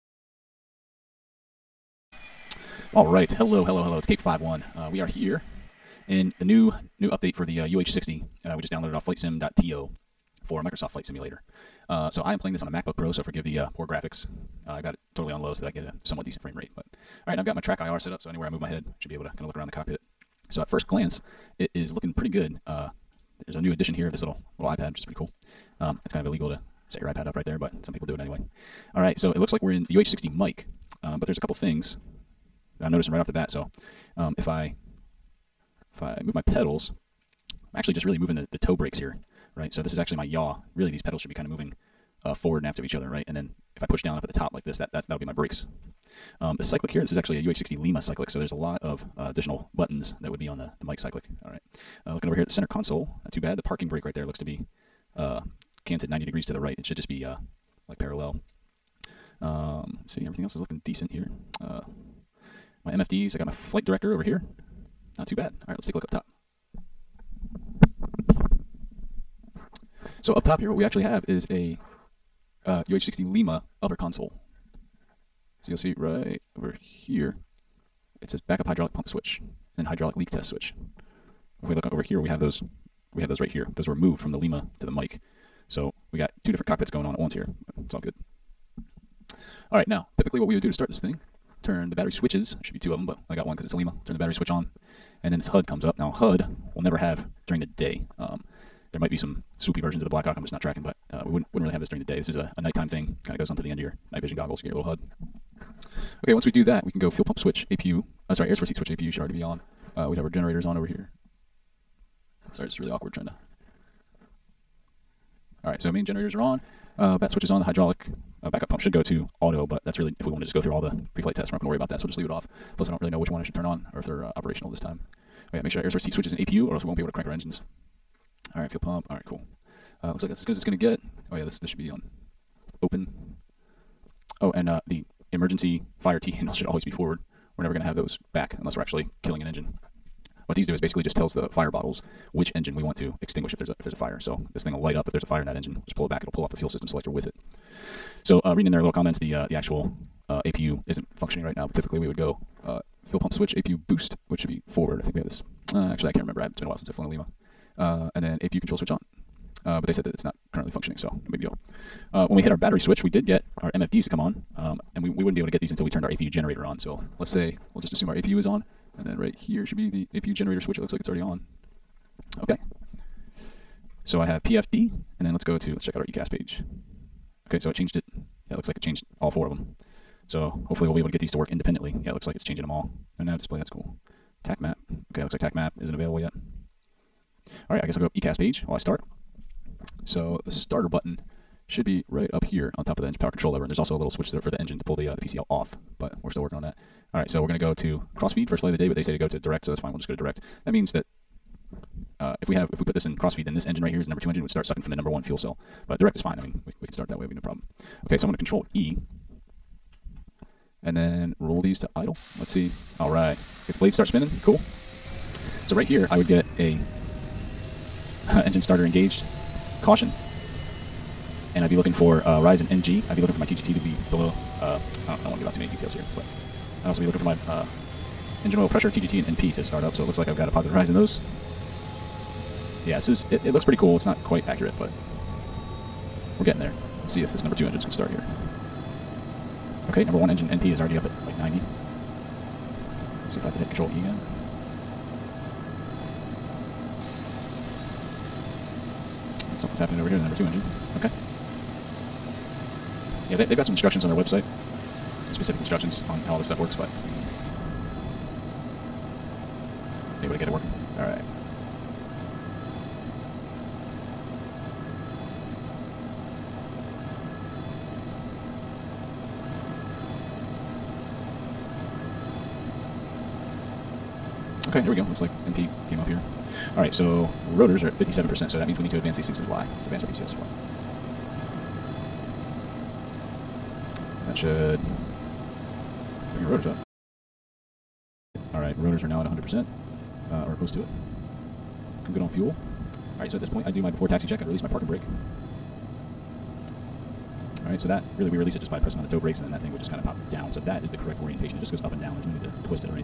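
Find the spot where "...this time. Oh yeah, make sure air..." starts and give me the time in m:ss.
2:04.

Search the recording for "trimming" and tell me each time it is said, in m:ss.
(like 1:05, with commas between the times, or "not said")
not said.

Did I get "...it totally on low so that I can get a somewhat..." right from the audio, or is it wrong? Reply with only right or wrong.
right.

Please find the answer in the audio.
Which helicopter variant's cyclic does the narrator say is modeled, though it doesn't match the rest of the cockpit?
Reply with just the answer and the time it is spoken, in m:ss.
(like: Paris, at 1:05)
UH60 Lima, at 0:47.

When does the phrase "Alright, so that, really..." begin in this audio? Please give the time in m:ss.
4:57.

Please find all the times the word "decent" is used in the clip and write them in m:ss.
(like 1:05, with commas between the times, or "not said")
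0:16, 1:00.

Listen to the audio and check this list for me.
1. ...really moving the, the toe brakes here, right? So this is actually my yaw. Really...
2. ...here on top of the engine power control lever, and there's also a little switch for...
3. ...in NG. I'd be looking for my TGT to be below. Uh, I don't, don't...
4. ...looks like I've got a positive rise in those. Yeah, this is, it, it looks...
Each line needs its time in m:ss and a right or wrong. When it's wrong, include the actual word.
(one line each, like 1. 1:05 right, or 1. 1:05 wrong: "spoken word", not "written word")
1. 0:38 right
2. 3:12 right
3. 3:42 right
4. 3:50 right.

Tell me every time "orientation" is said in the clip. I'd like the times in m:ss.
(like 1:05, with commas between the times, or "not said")
5:01.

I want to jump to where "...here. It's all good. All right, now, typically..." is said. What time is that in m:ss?
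1:27.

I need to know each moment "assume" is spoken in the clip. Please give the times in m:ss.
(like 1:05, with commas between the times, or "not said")
2:47.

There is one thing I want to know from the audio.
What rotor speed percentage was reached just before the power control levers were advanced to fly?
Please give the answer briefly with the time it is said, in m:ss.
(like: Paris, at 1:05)
57%, at 4:37.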